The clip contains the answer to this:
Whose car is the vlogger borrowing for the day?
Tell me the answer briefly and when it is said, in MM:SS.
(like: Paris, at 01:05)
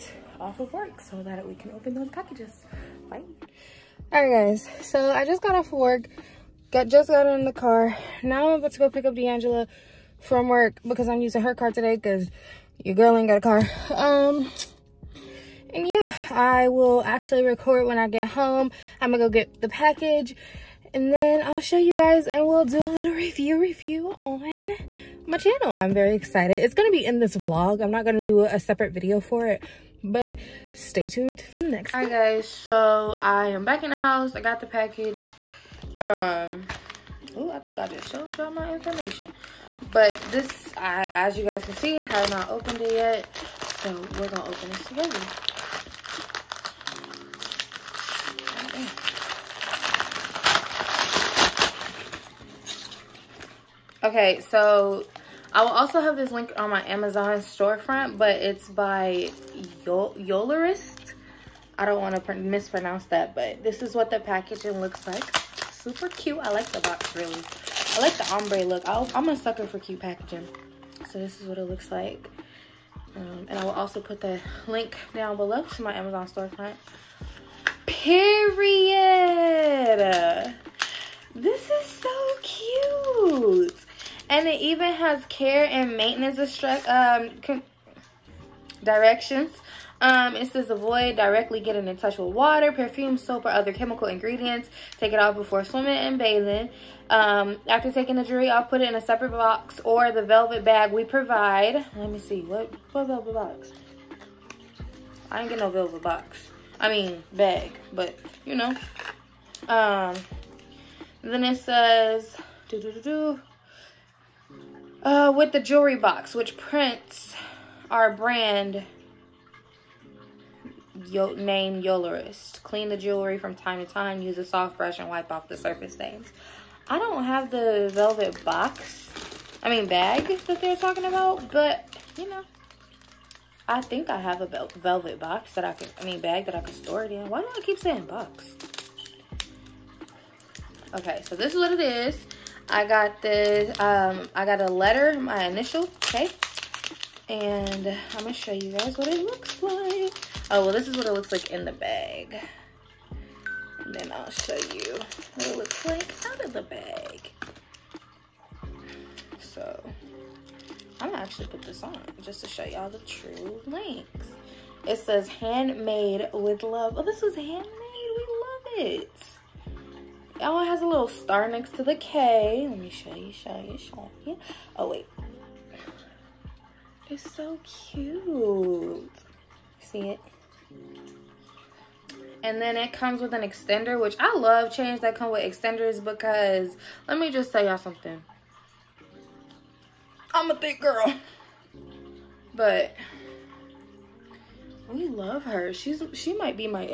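D'Angela, at 00:09.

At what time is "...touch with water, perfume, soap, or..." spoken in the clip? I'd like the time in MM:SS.
01:31.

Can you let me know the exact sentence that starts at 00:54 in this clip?
Okay, so I will also have this link on my Amazon storefront, but it's by Yolorist.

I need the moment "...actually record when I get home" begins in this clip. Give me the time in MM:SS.
00:17.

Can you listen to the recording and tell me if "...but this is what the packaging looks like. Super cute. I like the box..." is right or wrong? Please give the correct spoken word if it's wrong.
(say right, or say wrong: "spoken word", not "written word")
right.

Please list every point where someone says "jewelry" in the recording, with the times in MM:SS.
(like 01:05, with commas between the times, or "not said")
01:38, 01:55, 02:02.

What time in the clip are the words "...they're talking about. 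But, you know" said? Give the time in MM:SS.
02:10.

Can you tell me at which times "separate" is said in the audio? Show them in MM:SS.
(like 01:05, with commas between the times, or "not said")
00:28, 01:39.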